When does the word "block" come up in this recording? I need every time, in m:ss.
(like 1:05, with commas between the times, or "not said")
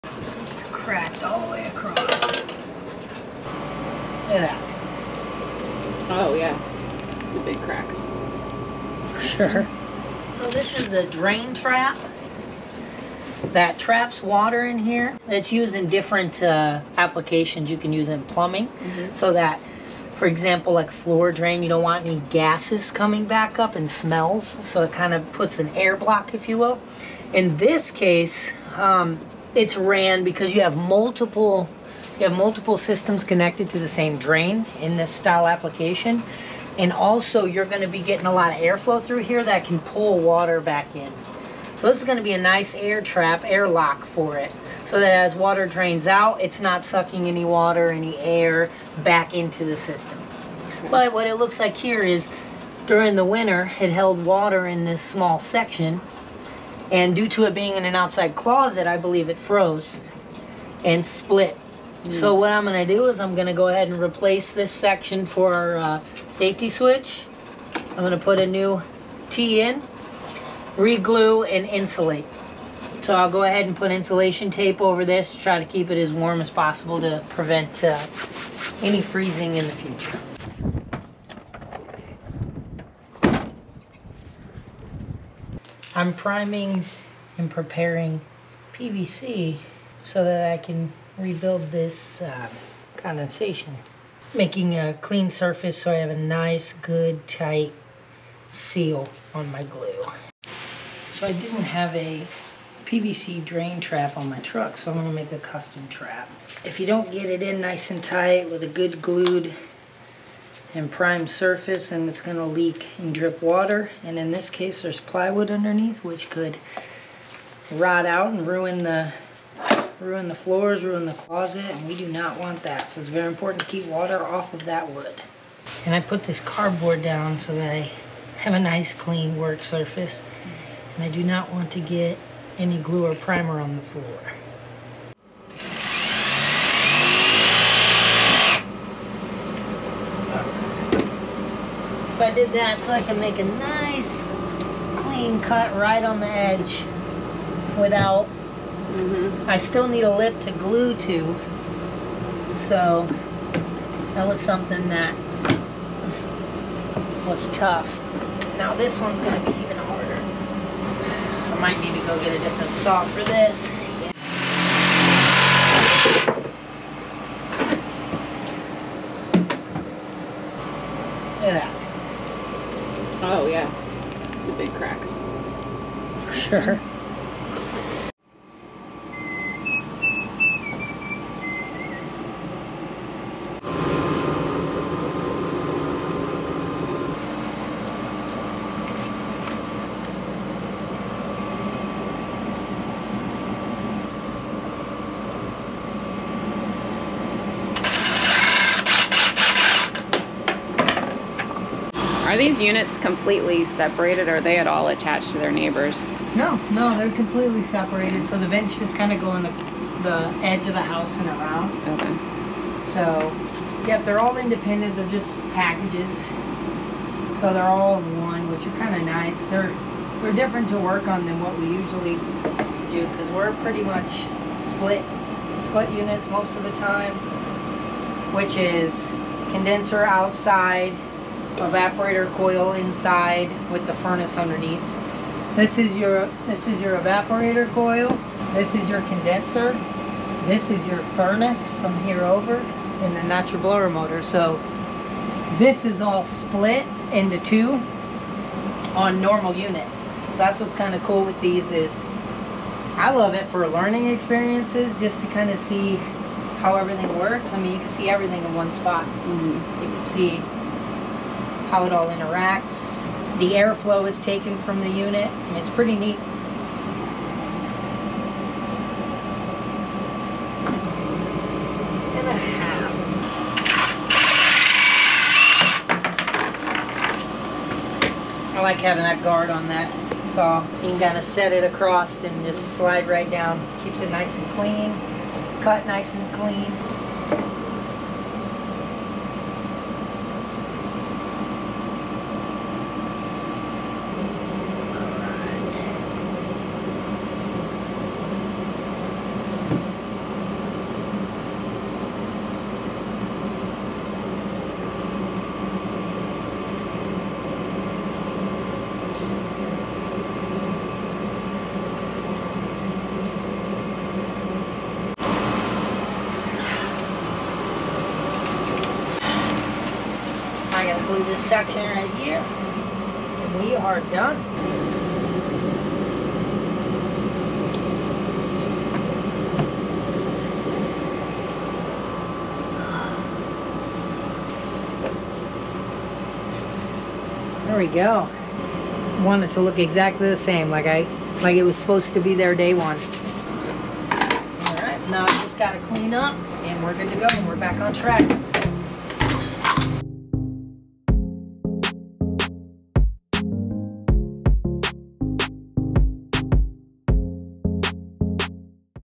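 0:25.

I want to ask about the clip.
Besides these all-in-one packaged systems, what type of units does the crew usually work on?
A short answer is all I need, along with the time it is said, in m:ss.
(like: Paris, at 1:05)
Split units, at 3:44.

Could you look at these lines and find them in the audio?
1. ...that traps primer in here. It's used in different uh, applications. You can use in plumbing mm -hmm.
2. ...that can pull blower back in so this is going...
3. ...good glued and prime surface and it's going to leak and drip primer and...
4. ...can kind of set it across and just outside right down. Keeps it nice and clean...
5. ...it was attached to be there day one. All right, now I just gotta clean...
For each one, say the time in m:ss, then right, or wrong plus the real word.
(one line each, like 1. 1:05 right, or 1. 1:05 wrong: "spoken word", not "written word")
1. 0:13 wrong: "water", not "primer"
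2. 0:39 wrong: "water", not "blower"
3. 1:48 wrong: "water", not "primer"
4. 4:40 wrong: "slide", not "outside"
5. 5:41 wrong: "supposed", not "attached".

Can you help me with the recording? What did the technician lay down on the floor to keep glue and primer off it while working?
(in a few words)
Cardboard.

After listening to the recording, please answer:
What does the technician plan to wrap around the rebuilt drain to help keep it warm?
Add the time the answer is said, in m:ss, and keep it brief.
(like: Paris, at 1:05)
Insulation tape, at 1:13.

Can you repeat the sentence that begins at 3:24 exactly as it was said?
Or are they at all attached to their neighbors?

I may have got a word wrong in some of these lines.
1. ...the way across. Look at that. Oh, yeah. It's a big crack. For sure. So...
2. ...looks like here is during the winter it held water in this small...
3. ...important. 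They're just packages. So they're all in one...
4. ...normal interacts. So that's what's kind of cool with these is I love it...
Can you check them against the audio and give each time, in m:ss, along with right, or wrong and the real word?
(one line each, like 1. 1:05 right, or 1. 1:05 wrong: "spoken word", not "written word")
1. 0:01 right
2. 0:51 right
3. 3:34 wrong: "independent", not "important"
4. 4:09 wrong: "units", not "interacts".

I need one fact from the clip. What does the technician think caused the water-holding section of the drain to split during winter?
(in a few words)
It froze.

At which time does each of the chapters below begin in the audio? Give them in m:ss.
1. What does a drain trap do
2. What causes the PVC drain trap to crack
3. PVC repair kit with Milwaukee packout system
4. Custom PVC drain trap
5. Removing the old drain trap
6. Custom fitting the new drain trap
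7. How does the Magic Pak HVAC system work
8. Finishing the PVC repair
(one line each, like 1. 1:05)
1. 0:11
2. 0:50
3. 1:19
4. 1:40
5. 2:18
6. 3:14
7. 3:25
8. 5:32.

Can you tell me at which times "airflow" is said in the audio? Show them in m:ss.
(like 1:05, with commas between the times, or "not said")
0:38, 4:23.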